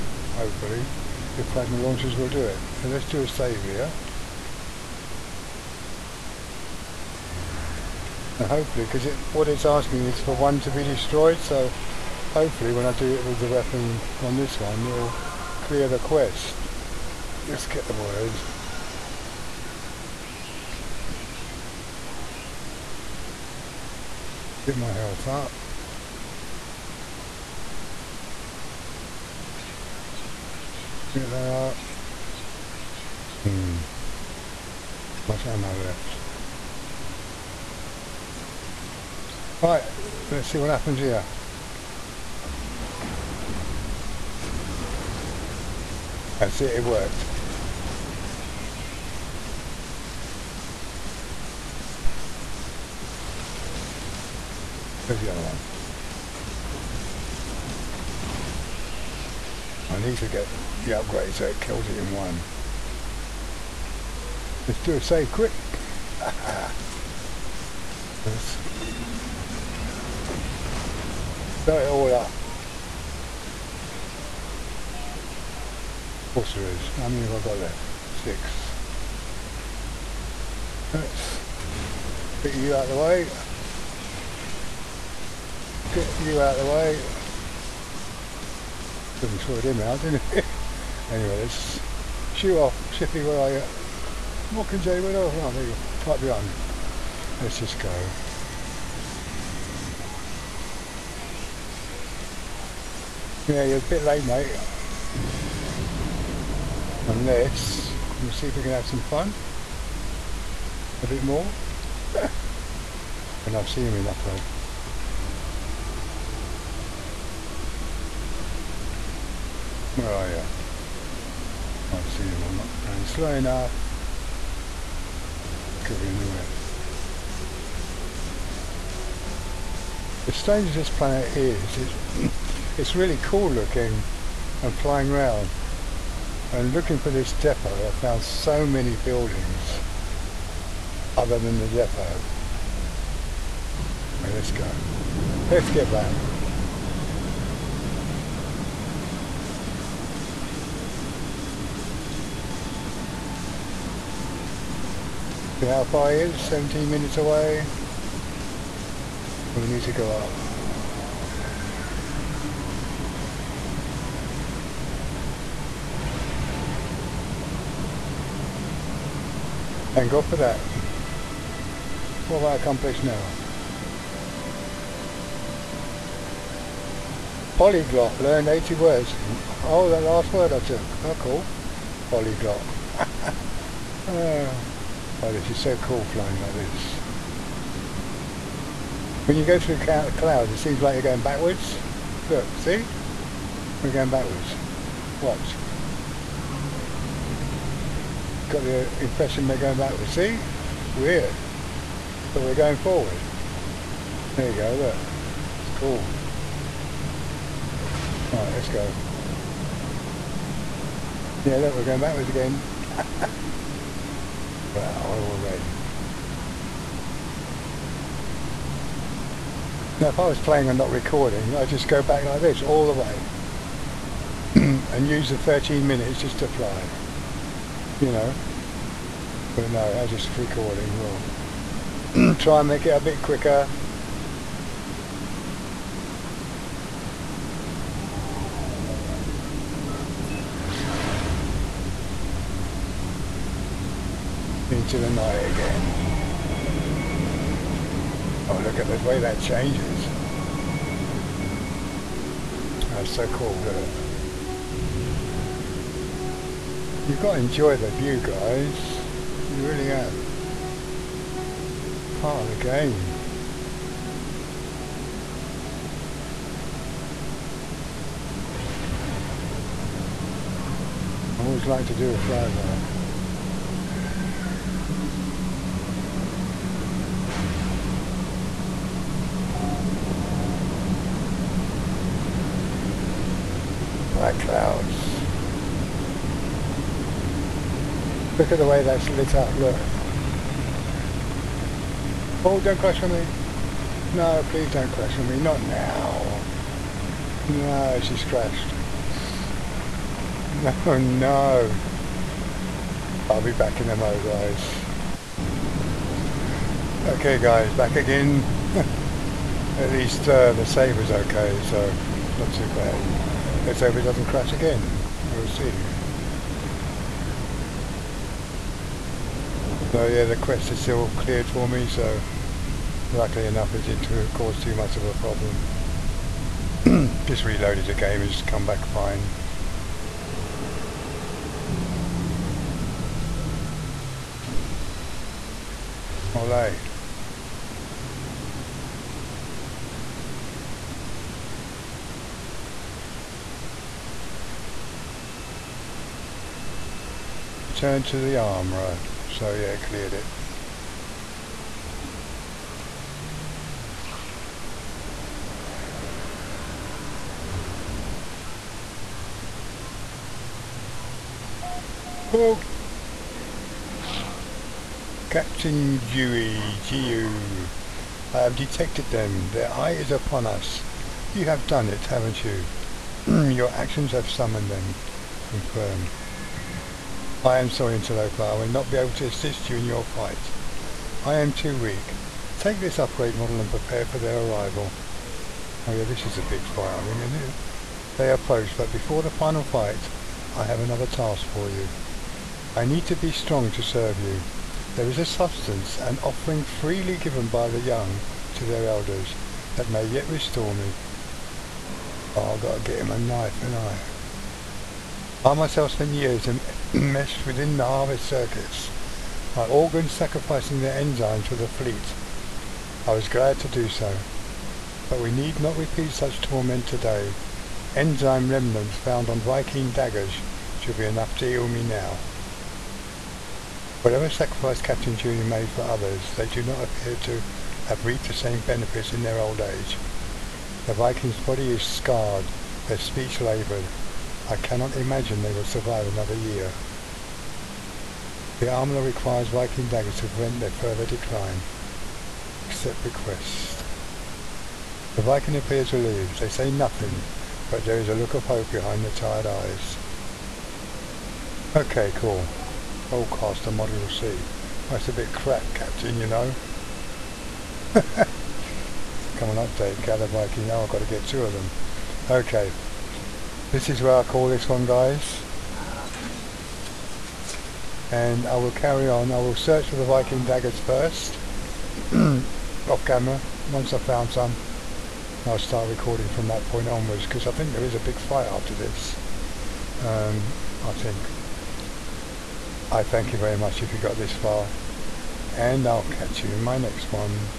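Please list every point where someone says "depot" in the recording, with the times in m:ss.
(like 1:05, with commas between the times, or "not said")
2:17, 2:21.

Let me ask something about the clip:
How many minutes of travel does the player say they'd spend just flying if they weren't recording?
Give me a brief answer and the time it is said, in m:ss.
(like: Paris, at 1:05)
13, at 3:45.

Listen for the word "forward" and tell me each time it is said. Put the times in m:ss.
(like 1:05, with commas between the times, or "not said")
3:22.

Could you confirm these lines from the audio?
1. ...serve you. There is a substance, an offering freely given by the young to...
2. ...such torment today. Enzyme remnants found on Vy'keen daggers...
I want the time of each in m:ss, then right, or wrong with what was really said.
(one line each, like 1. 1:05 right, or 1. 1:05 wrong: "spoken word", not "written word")
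1. 6:33 right
2. 6:56 right.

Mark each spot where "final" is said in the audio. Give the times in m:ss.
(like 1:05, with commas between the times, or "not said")
6:29.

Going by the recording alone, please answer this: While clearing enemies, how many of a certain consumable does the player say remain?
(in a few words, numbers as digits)
6.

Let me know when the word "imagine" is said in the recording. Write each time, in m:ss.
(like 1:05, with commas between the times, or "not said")
7:14.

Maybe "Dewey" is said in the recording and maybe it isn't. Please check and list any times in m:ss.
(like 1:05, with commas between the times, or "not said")
6:05, 7:05.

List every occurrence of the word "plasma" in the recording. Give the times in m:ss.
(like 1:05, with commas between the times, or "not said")
0:01.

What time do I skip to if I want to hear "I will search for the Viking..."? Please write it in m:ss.
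7:49.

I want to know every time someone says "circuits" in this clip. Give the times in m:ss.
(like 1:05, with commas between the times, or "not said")
6:48.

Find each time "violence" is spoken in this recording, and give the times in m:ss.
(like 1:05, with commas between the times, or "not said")
not said.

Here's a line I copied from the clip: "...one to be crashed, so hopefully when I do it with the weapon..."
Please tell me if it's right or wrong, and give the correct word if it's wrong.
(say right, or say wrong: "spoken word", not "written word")
wrong: "destroyed", not "crashed".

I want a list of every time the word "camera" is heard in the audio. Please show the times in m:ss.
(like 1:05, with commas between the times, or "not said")
7:53.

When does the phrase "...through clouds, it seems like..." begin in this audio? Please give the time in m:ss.
3:09.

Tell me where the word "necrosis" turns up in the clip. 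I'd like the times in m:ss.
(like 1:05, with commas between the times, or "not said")
not said.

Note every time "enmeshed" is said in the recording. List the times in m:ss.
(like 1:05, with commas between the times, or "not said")
6:46.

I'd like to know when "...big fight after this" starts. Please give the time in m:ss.
7:57.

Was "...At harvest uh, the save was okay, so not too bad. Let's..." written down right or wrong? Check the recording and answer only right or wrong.
wrong.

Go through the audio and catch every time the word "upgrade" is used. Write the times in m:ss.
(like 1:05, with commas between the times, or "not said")
1:00, 6:22.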